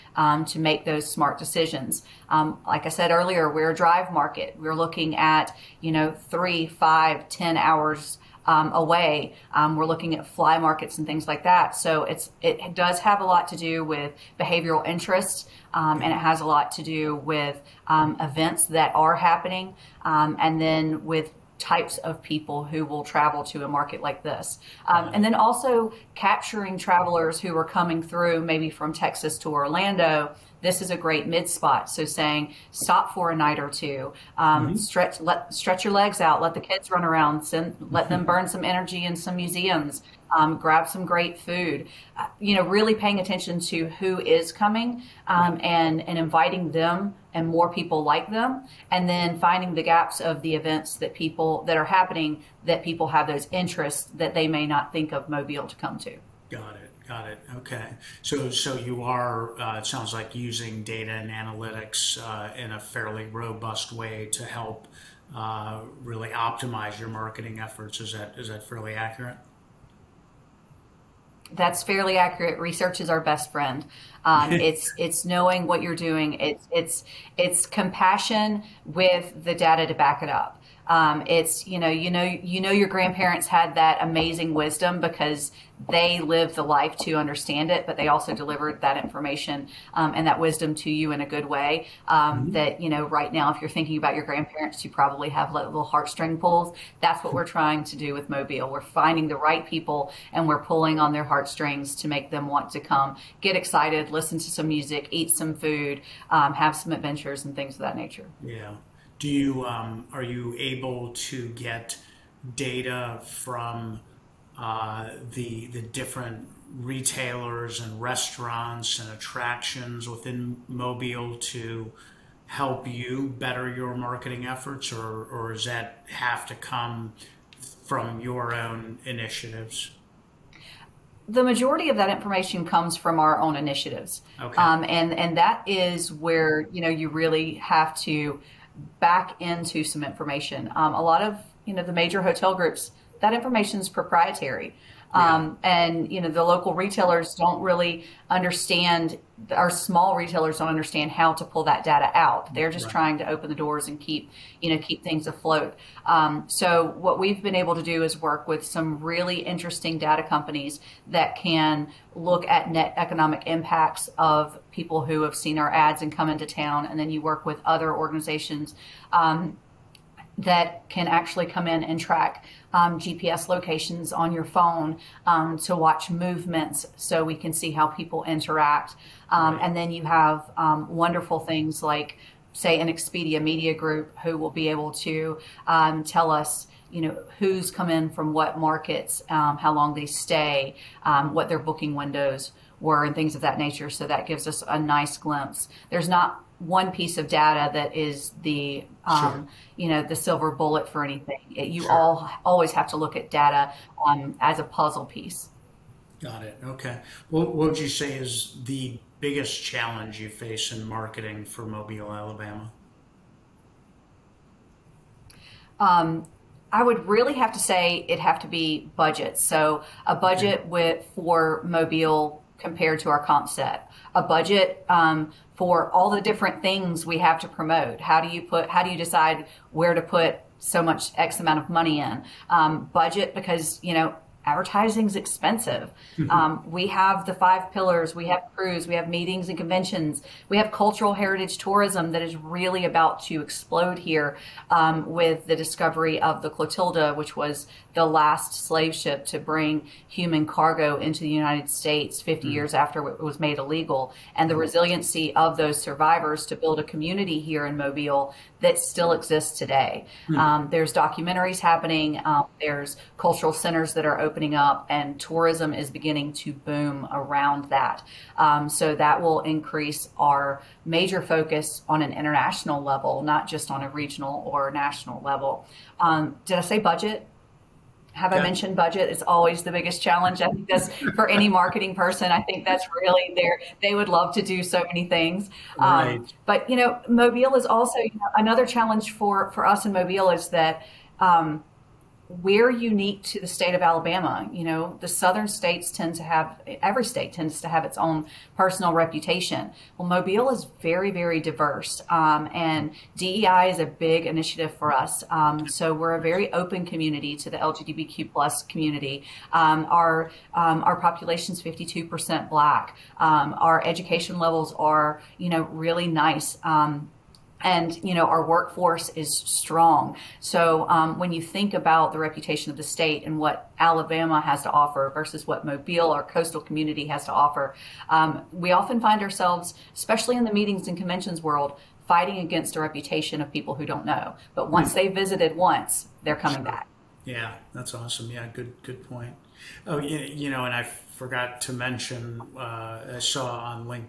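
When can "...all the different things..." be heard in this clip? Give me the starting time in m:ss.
3:45.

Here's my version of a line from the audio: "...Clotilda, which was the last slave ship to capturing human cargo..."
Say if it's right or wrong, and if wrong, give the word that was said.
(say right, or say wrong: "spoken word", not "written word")
wrong: "bring", not "capturing".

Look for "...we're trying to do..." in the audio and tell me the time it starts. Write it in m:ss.
1:37.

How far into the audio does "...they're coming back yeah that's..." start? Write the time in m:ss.
5:36.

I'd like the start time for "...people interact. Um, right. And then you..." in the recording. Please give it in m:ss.
2:57.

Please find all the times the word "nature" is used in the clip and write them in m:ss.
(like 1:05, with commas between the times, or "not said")
1:47, 3:13.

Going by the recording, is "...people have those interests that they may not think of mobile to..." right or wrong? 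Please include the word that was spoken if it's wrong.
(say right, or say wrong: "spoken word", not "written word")
right.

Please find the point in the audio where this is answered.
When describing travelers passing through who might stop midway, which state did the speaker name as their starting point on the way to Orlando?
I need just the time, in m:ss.
0:28.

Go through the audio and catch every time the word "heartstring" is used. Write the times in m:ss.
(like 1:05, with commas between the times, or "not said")
1:35, 1:41.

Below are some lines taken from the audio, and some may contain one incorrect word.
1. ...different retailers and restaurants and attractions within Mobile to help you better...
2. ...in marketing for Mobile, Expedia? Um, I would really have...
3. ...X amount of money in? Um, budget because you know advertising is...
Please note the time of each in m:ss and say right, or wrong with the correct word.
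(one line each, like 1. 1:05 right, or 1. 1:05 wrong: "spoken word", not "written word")
1. 1:55 right
2. 3:30 wrong: "Alabama", not "Expedia"
3. 3:51 right.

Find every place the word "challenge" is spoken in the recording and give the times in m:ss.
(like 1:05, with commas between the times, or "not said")
3:29, 4:40, 4:48.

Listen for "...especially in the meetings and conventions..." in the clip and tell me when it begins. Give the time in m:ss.
5:29.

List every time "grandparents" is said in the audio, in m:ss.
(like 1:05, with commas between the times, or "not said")
1:22, 1:34.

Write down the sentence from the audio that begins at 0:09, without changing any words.
Um, we're looking at fly markets and things like that.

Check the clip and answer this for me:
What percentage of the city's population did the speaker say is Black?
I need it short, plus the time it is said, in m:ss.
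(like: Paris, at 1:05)
52%, at 5:11.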